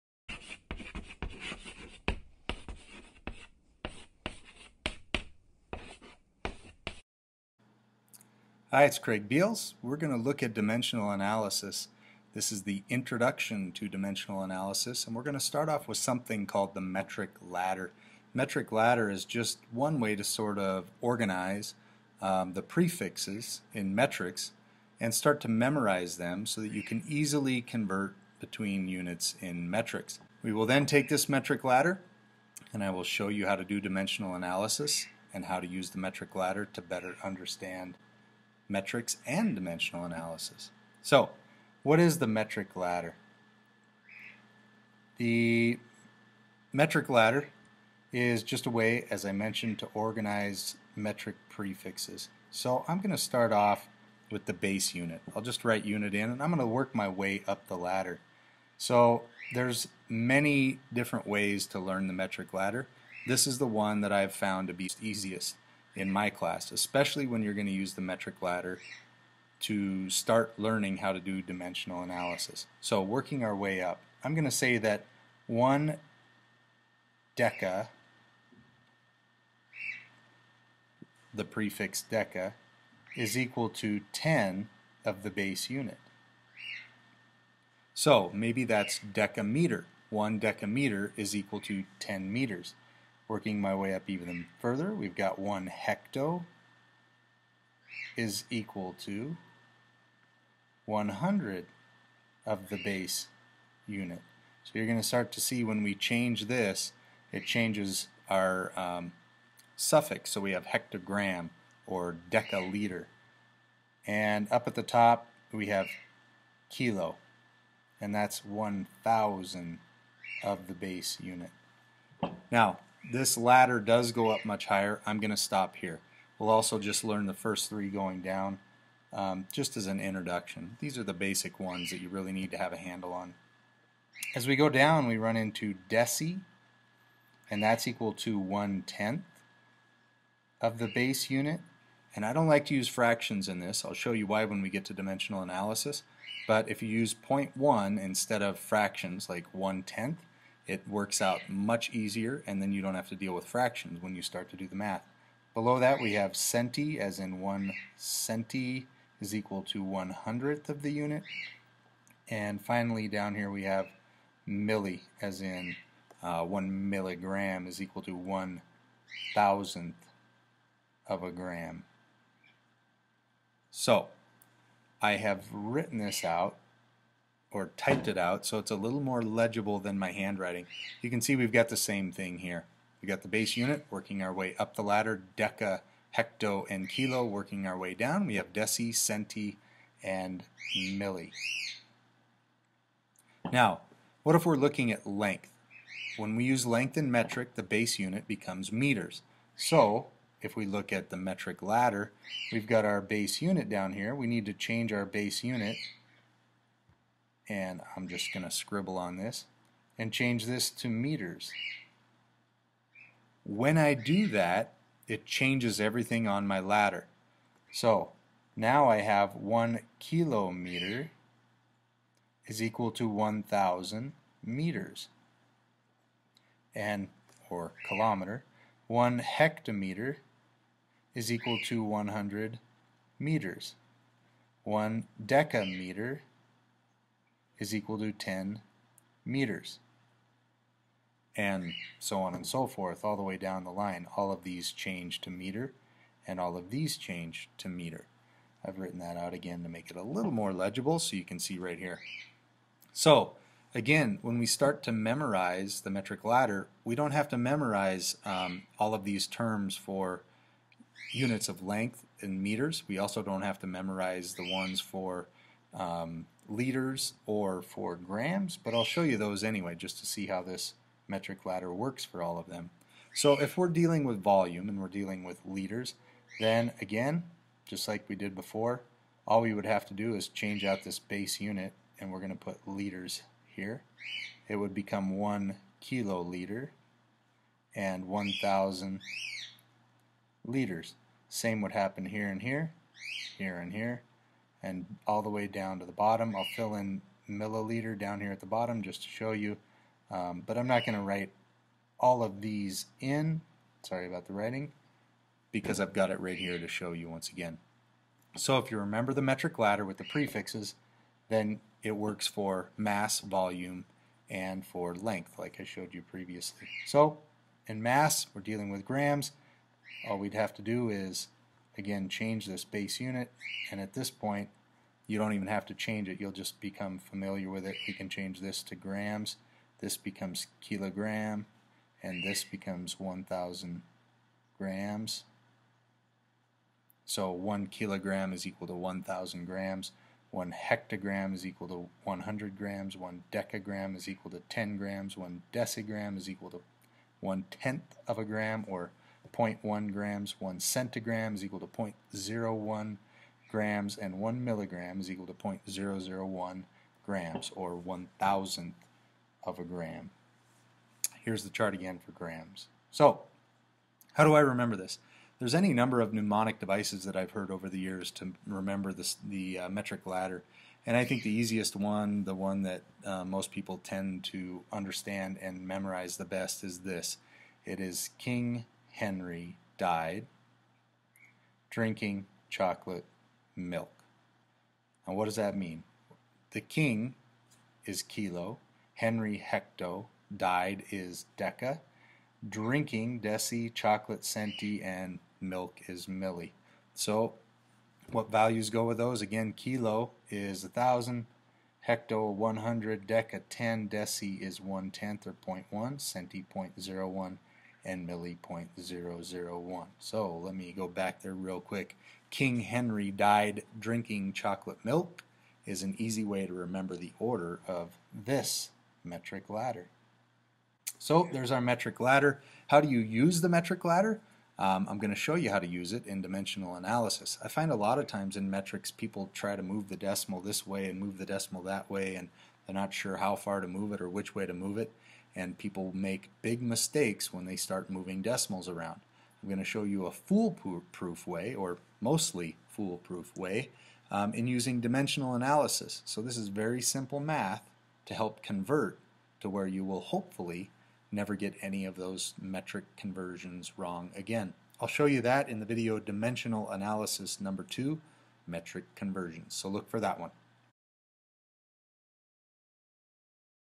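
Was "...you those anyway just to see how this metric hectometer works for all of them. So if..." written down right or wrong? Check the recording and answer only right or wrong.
wrong.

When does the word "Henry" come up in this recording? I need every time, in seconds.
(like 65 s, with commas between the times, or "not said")
378 s, 388 s, 412 s.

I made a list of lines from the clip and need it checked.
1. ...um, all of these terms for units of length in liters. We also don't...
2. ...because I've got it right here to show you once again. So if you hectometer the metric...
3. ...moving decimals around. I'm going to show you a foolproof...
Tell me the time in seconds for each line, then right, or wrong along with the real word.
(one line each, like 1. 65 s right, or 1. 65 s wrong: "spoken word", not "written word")
1. 258 s wrong: "meters", not "liters"
2. 305 s wrong: "remember", not "hectometer"
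3. 437 s right.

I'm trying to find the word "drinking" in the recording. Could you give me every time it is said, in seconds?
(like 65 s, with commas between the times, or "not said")
381 s, 392 s, 413 s.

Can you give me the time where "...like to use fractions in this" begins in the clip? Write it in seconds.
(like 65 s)
142 s.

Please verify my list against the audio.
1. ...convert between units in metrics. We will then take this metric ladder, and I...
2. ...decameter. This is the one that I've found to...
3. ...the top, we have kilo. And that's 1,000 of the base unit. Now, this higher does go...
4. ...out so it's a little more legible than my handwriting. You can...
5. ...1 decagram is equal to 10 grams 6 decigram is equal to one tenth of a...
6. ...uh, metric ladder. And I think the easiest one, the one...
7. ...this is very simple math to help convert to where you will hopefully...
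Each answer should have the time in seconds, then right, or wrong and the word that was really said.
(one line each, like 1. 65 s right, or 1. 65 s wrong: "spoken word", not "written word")
1. 27 s right
2. 62 s wrong: "ladder", not "decameter"
3. 114 s wrong: "ladder", not "higher"
4. 178 s right
5. 342 s wrong: "1", not "6"
6. 369 s right
7. 446 s right.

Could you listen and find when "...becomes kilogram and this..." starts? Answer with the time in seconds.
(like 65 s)
329 s.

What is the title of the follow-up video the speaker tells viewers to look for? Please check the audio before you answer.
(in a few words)
Dimensional Analysis number 2, Metric Conversions.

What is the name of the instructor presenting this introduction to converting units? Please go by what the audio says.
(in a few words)
Craig Beals.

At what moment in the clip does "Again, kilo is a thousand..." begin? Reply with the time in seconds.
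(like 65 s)
399 s.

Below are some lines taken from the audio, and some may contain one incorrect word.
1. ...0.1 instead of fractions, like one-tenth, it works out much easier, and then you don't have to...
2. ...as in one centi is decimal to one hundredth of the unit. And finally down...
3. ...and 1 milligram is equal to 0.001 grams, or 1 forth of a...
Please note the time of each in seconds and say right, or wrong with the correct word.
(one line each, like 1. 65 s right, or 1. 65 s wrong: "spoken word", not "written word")
1. 147 s right
2. 156 s wrong: "equal", not "decimal"
3. 353 s wrong: "thousandth", not "forth".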